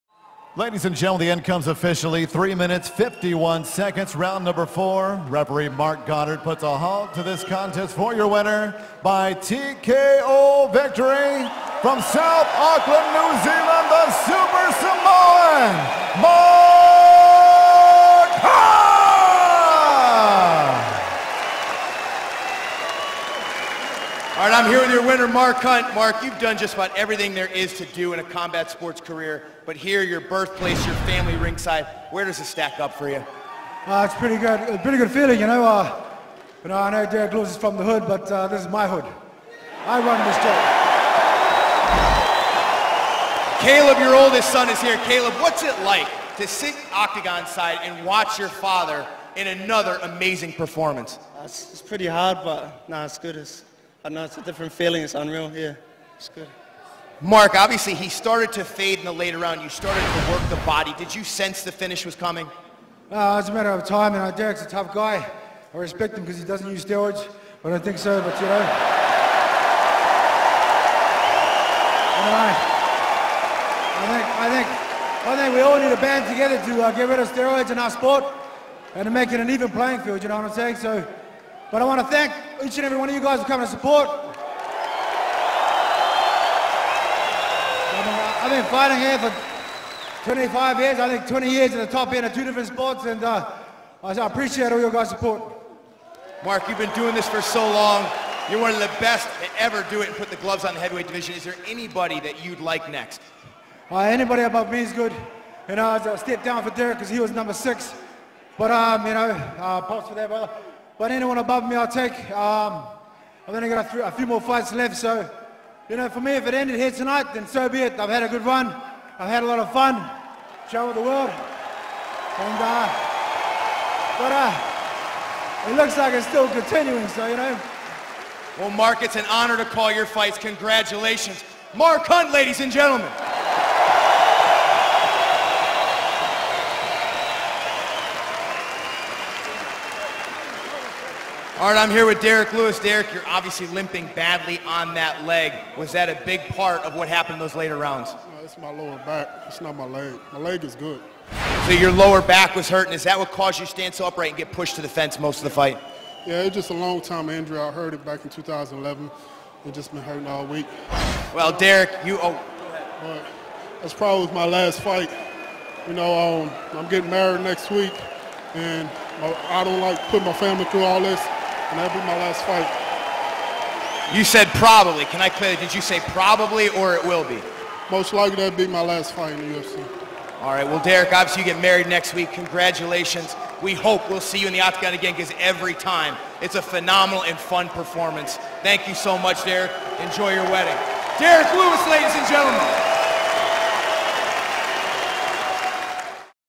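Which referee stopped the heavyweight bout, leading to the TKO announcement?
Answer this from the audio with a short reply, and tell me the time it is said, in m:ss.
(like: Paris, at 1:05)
Marc Goddard, at 0:05.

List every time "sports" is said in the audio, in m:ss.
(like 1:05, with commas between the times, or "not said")
0:28, 1:17, 1:32.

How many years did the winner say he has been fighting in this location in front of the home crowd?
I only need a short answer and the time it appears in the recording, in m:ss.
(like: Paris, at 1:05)
25, at 1:30.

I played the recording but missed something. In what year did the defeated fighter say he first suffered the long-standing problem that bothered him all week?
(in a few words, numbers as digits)
2011.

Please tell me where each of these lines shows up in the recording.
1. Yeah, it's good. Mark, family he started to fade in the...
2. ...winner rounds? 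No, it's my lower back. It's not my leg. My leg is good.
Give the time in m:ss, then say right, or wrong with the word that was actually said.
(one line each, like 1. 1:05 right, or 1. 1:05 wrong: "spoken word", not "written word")
1. 0:55 wrong: "obviously", not "family"
2. 2:27 wrong: "later", not "winner".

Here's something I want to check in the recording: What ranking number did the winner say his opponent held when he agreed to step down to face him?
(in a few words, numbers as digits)
6.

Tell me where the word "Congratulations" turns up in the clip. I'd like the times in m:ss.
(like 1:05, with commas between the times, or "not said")
2:10, 3:02.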